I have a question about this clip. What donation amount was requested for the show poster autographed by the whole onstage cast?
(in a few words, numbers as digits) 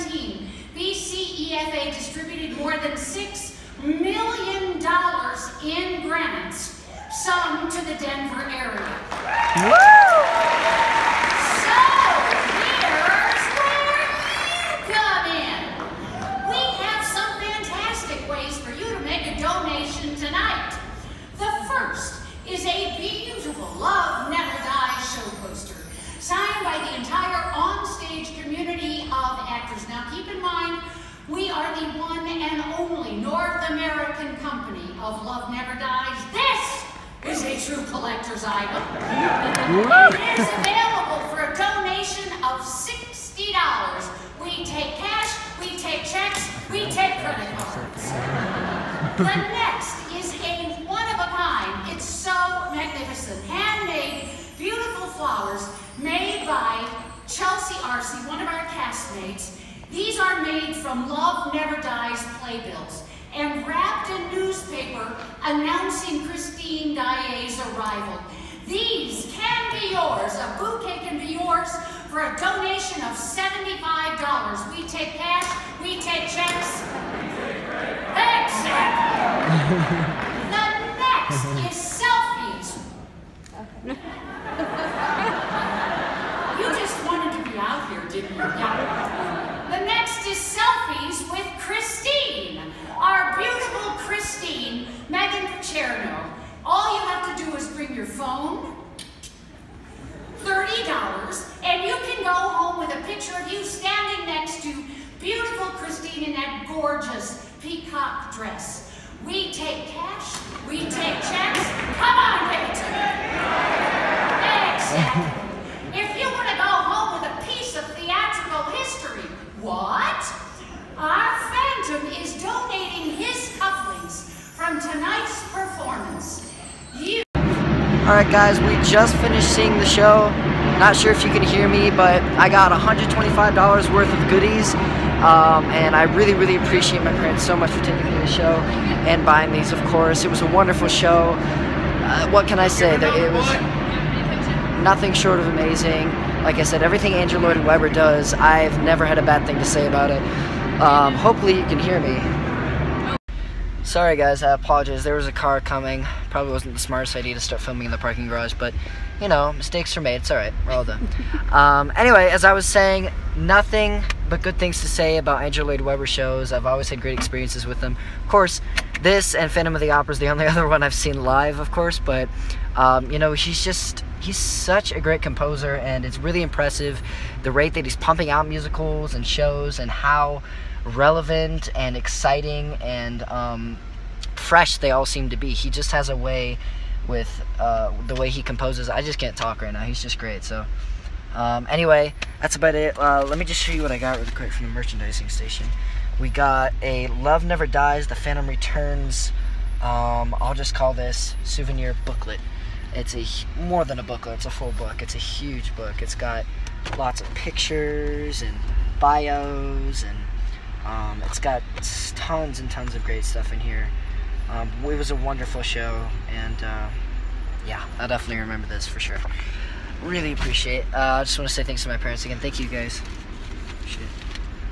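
$60.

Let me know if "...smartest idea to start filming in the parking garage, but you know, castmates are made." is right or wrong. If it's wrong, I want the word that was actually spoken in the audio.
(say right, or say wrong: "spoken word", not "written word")
wrong: "mistakes", not "castmates".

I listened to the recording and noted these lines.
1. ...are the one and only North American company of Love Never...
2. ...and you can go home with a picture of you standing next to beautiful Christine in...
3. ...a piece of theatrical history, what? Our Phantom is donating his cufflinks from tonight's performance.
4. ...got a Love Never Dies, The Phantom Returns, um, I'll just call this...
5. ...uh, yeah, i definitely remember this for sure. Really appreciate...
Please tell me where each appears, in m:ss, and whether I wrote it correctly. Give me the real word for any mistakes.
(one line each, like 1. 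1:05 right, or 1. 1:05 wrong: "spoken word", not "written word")
1. 0:31 right
2. 1:41 right
3. 1:57 right
4. 3:16 right
5. 3:36 right.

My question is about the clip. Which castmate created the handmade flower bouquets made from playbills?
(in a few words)
Chelsea Arcy.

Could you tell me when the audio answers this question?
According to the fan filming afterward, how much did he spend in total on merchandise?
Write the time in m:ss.
2:12.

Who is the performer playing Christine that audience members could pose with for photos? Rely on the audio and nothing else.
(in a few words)
Meghan Picerno.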